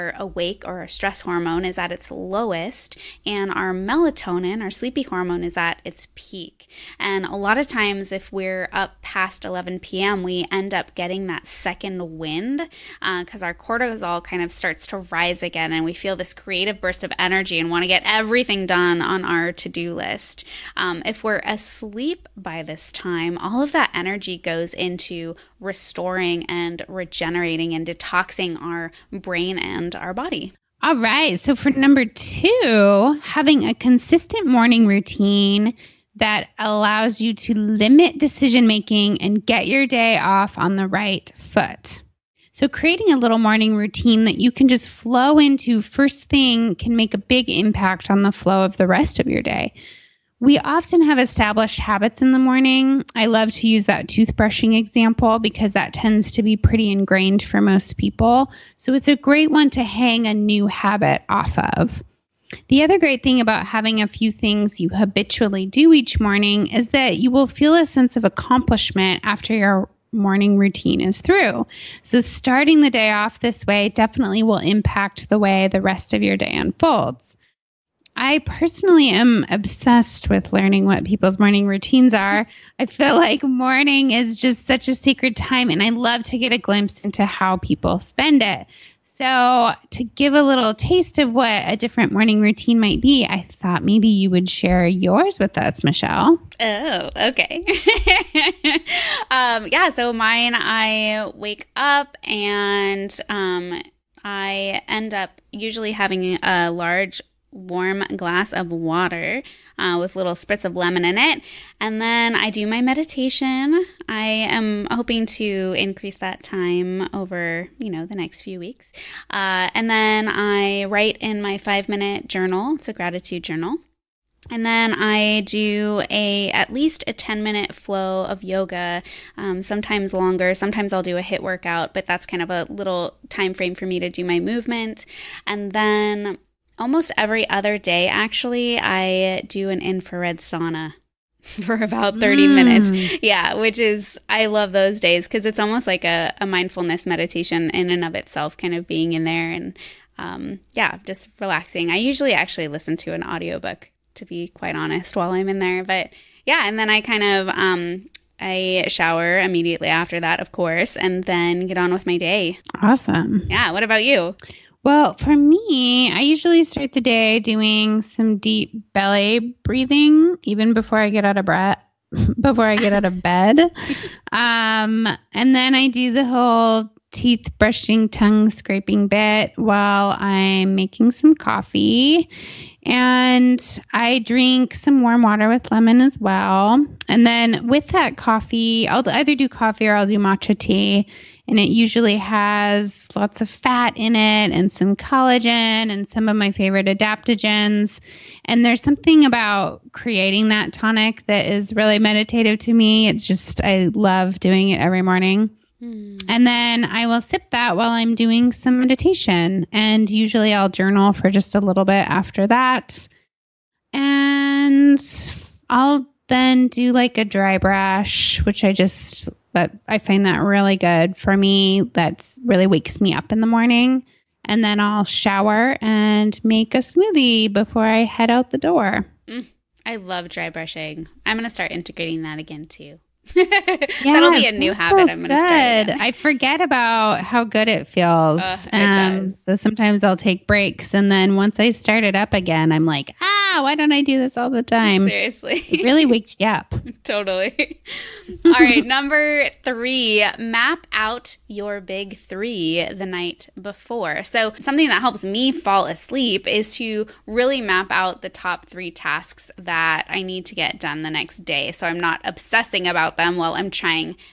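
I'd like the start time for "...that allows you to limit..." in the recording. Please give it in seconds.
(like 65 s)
36 s.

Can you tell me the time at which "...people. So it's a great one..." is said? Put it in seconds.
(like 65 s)
57 s.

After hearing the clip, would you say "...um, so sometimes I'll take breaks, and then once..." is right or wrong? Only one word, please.
right.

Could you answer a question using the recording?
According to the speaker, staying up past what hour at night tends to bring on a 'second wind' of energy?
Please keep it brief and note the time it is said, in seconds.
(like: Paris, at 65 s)
11 p.m., at 9 s.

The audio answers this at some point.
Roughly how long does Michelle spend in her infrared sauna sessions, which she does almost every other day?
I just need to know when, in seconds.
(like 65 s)
142 s.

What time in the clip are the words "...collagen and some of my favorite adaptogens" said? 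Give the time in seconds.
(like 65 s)
194 s.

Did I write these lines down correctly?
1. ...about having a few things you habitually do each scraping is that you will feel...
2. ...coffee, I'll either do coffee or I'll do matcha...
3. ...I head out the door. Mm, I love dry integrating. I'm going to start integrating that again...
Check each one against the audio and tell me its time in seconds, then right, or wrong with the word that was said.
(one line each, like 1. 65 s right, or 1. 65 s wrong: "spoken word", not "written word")
1. 63 s wrong: "morning", not "scraping"
2. 188 s right
3. 227 s wrong: "brushing", not "integrating".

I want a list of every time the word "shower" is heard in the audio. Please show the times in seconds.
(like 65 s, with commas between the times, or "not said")
158 s, 225 s.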